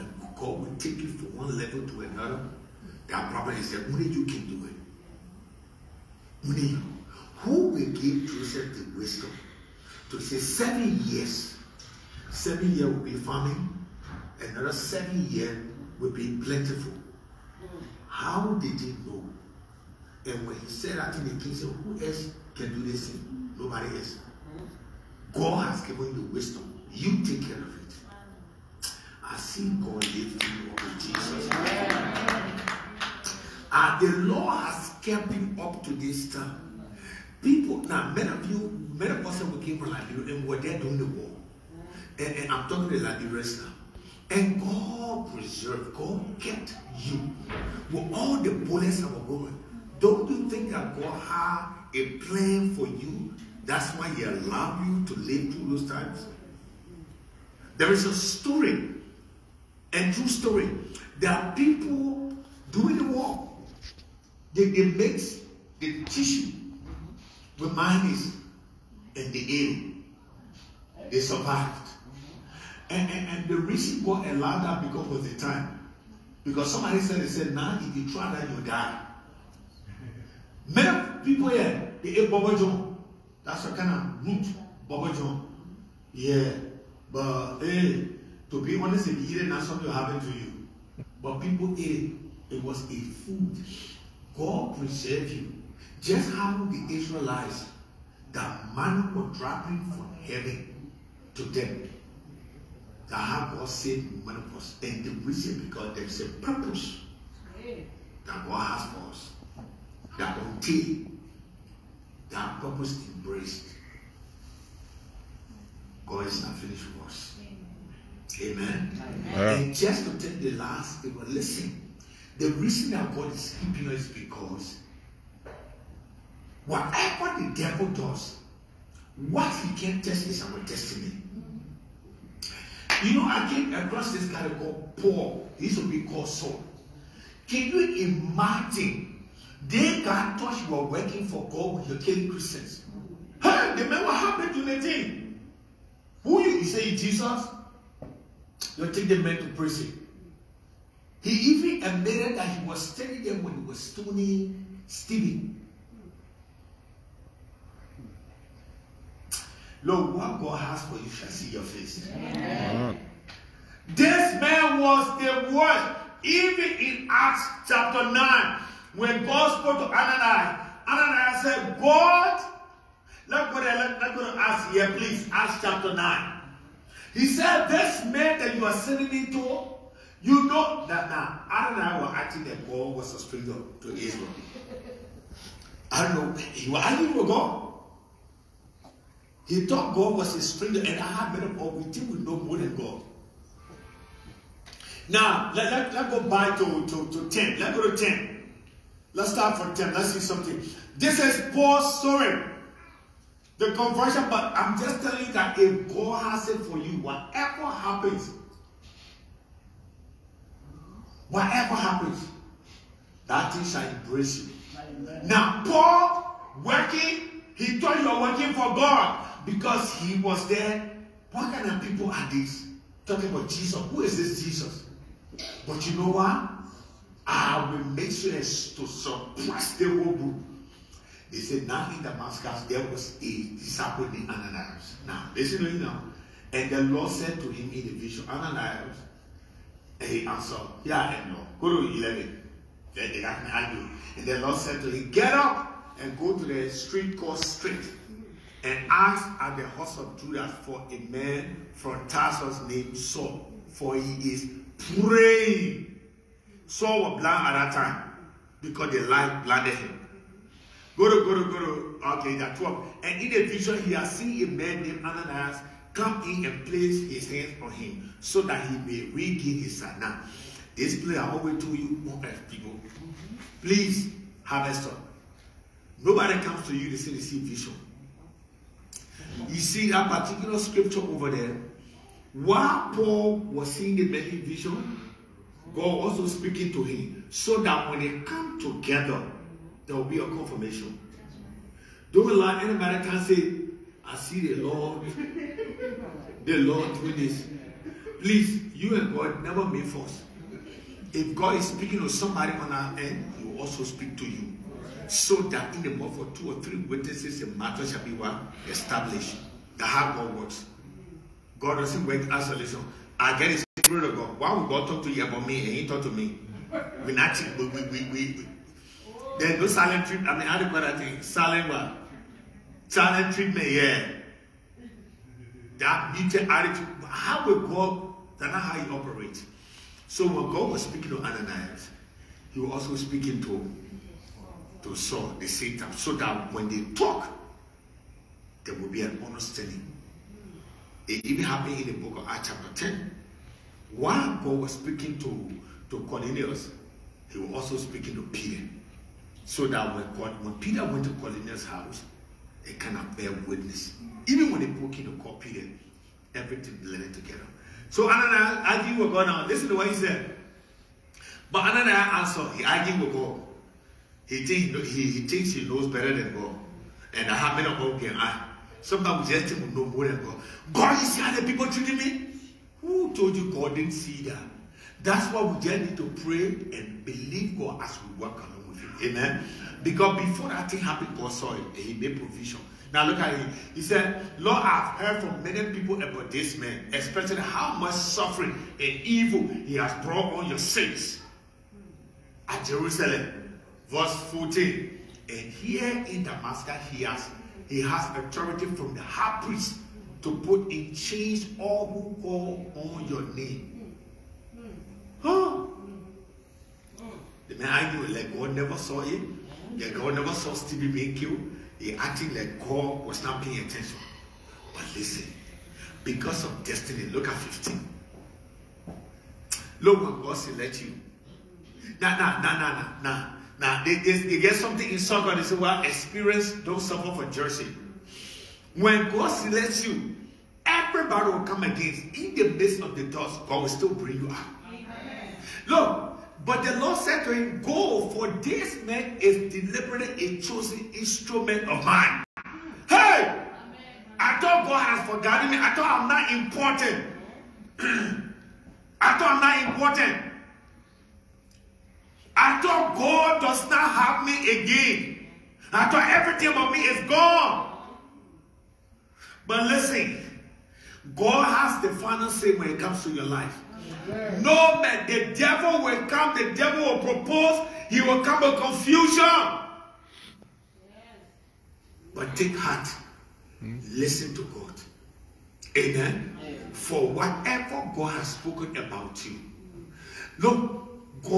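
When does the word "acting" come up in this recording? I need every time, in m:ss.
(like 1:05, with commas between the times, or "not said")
3:02, 6:51.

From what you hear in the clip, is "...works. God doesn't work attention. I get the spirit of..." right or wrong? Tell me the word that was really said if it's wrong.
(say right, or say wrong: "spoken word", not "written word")
wrong: "isolation", not "attention".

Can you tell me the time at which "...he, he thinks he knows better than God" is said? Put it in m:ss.
6:04.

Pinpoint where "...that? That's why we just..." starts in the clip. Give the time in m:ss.
6:14.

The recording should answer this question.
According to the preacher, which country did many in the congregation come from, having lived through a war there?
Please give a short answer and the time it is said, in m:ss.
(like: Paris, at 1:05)
Liberia, at 0:39.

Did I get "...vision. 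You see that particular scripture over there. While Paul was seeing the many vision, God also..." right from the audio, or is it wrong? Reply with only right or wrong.
right.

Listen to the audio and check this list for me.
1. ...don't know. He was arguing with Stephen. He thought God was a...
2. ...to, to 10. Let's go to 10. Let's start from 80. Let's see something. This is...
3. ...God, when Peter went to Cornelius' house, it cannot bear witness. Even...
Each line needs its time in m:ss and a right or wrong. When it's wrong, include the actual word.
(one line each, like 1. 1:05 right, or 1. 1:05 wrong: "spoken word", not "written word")
1. 3:06 wrong: "God", not "Stephen"
2. 3:16 wrong: "10", not "80"
3. 5:50 right.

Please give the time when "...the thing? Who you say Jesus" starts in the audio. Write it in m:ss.
2:24.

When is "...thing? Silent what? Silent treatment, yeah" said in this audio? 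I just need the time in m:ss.
5:20.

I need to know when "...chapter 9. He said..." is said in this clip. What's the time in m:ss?
2:55.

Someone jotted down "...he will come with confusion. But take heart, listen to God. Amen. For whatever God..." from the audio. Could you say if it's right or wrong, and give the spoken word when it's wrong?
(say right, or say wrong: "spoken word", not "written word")
right.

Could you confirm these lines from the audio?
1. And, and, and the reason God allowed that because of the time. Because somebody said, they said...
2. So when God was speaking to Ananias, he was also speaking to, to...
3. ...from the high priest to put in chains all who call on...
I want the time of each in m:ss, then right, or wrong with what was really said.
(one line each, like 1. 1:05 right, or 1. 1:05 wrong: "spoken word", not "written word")
1. 1:12 right
2. 5:30 right
3. 6:38 right.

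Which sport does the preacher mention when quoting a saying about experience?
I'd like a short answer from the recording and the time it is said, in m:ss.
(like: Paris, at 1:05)
soccer, at 7:04.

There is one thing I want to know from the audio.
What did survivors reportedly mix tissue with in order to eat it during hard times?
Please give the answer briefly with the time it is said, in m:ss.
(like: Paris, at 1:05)
mayonnaise, at 1:07.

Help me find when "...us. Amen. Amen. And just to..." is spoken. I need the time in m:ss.
1:57.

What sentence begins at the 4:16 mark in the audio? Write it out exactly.
Saul was blind at that time because the light blinded him.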